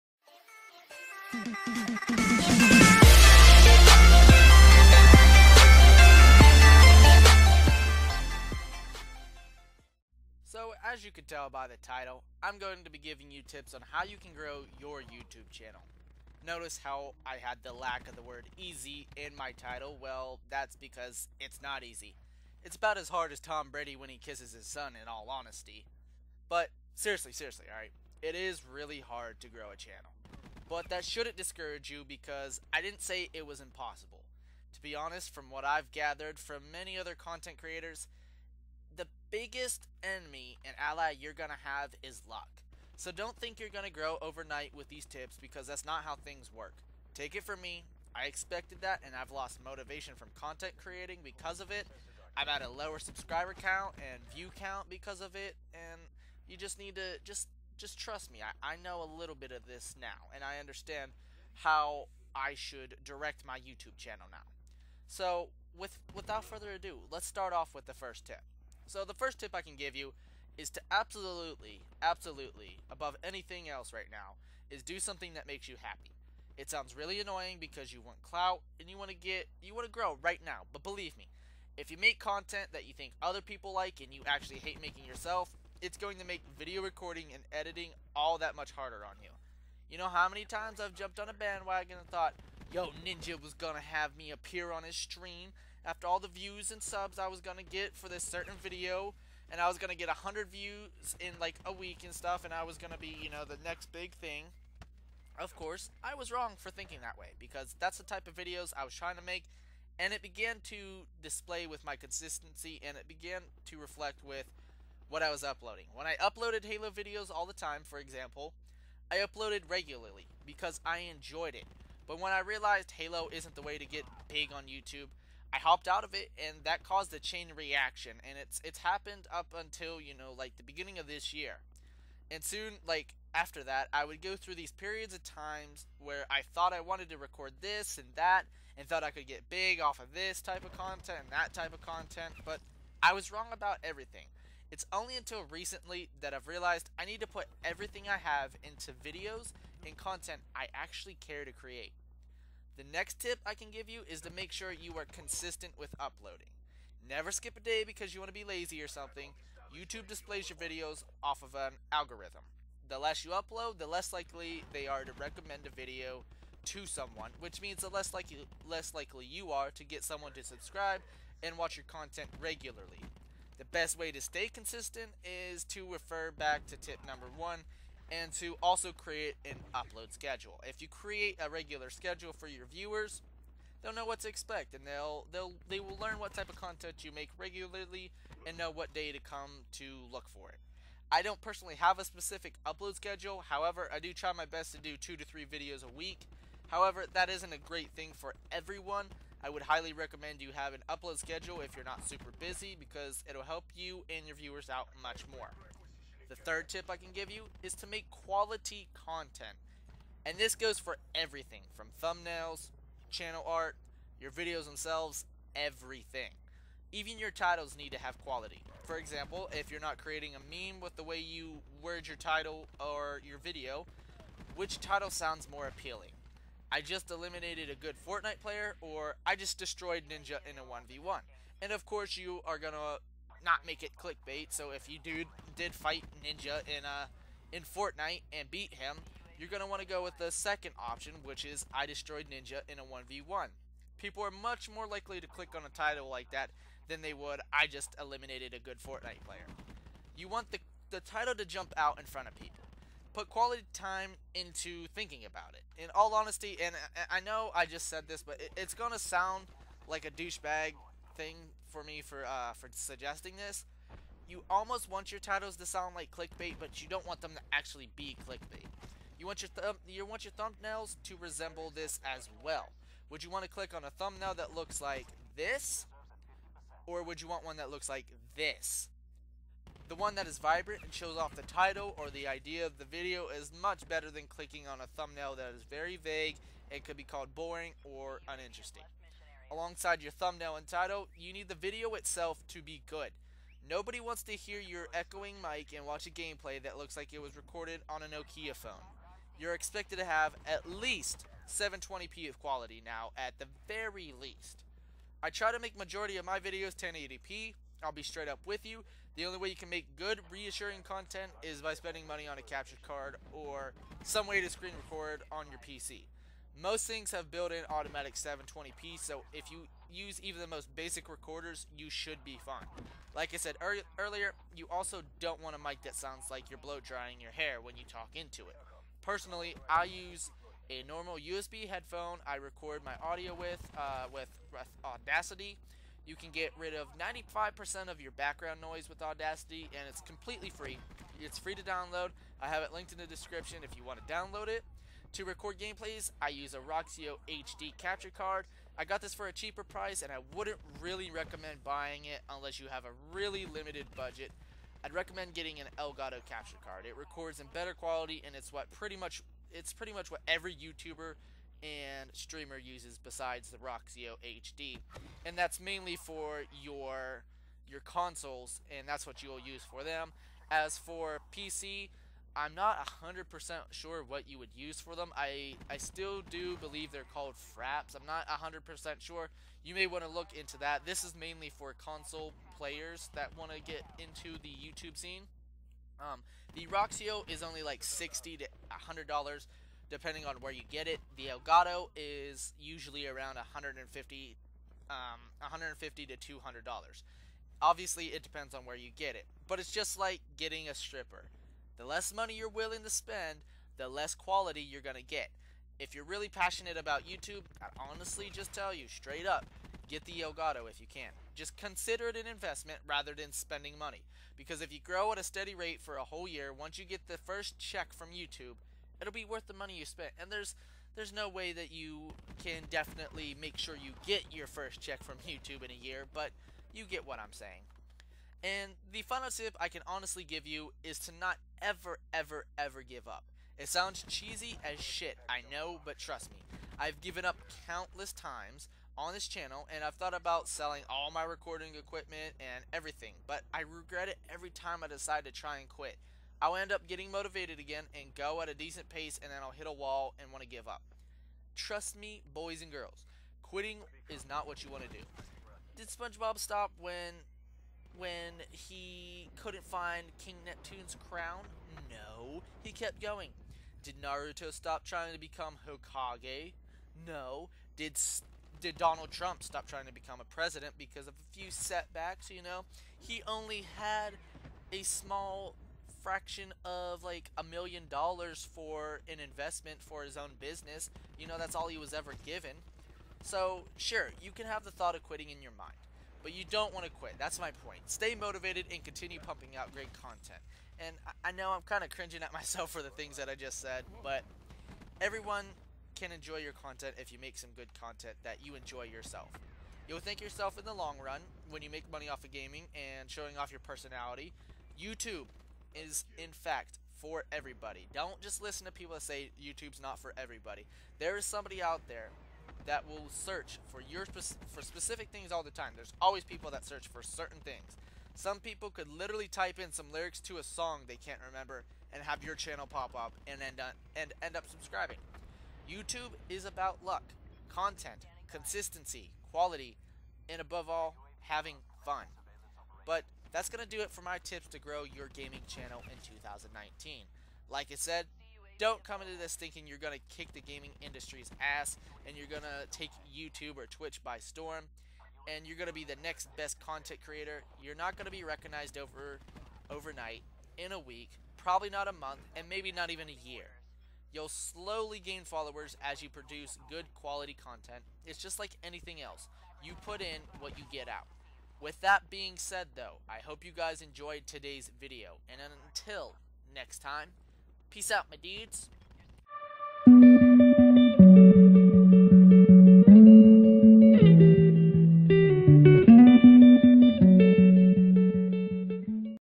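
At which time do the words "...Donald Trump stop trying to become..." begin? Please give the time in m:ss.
7:48.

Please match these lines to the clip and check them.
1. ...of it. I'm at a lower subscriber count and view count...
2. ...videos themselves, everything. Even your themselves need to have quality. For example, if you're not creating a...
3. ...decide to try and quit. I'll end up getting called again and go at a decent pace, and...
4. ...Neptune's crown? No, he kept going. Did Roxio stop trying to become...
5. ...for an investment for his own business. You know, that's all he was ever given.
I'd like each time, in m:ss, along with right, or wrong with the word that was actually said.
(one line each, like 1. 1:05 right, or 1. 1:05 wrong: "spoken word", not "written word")
1. 0:51 right
2. 3:34 wrong: "titles", not "themselves"
3. 7:24 wrong: "motivated", not "called"
4. 7:40 wrong: "Naruto", not "Roxio"
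5. 7:58 right.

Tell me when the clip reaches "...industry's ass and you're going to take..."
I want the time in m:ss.
9:00.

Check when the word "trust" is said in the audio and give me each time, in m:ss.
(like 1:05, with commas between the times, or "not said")
0:57, 7:15, 7:31.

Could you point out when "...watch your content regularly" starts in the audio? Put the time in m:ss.
2:51.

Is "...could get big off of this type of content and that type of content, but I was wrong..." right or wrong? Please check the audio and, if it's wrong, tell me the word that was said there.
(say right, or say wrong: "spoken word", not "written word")
right.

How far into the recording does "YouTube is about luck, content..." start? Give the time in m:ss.
8:45.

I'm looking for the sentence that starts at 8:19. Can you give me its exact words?
You'll thank yourself in the long run when you make money off of gaming and showing off your personality.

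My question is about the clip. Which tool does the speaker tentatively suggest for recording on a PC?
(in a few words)
fraps.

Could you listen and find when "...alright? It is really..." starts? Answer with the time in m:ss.
0:27.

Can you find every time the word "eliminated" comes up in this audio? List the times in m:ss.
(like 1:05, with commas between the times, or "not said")
3:47, 4:07.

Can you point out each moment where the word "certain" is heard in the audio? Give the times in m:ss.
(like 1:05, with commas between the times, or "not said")
1:38, 8:37.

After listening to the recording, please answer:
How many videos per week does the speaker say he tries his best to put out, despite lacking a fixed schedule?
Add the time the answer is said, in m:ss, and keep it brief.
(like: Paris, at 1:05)
2 to 3, at 3:14.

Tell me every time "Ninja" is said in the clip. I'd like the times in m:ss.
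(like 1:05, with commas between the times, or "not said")
1:33, 3:50, 3:56, 4:02.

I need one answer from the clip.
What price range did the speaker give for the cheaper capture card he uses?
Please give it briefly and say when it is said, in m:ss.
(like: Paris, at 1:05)
60 to $100, at 6:27.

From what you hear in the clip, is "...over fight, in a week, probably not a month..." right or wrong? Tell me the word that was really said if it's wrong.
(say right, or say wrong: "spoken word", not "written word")
wrong: "overnight", not "fight".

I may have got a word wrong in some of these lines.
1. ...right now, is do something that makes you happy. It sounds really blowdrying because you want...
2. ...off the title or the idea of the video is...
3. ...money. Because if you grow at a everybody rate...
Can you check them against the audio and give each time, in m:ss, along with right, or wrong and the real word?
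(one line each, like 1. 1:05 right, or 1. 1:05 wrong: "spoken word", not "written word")
1. 1:13 wrong: "annoying", not "blowdrying"
2. 4:41 right
3. 6:53 wrong: "steady", not "everybody".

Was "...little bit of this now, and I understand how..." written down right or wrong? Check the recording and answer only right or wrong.
right.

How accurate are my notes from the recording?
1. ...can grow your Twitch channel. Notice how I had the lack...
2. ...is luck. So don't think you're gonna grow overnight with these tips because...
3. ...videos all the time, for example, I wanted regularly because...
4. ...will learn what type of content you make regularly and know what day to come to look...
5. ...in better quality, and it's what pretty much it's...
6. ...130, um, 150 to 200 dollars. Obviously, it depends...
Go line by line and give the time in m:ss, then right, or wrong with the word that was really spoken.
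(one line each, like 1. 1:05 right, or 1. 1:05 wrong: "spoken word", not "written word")
1. 0:14 wrong: "YouTube", not "Twitch"
2. 0:42 right
3. 1:56 wrong: "uploaded", not "wanted"
4. 3:05 right
5. 5:57 right
6. 6:33 wrong: "150", not "130".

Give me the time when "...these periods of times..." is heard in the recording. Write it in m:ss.
2:14.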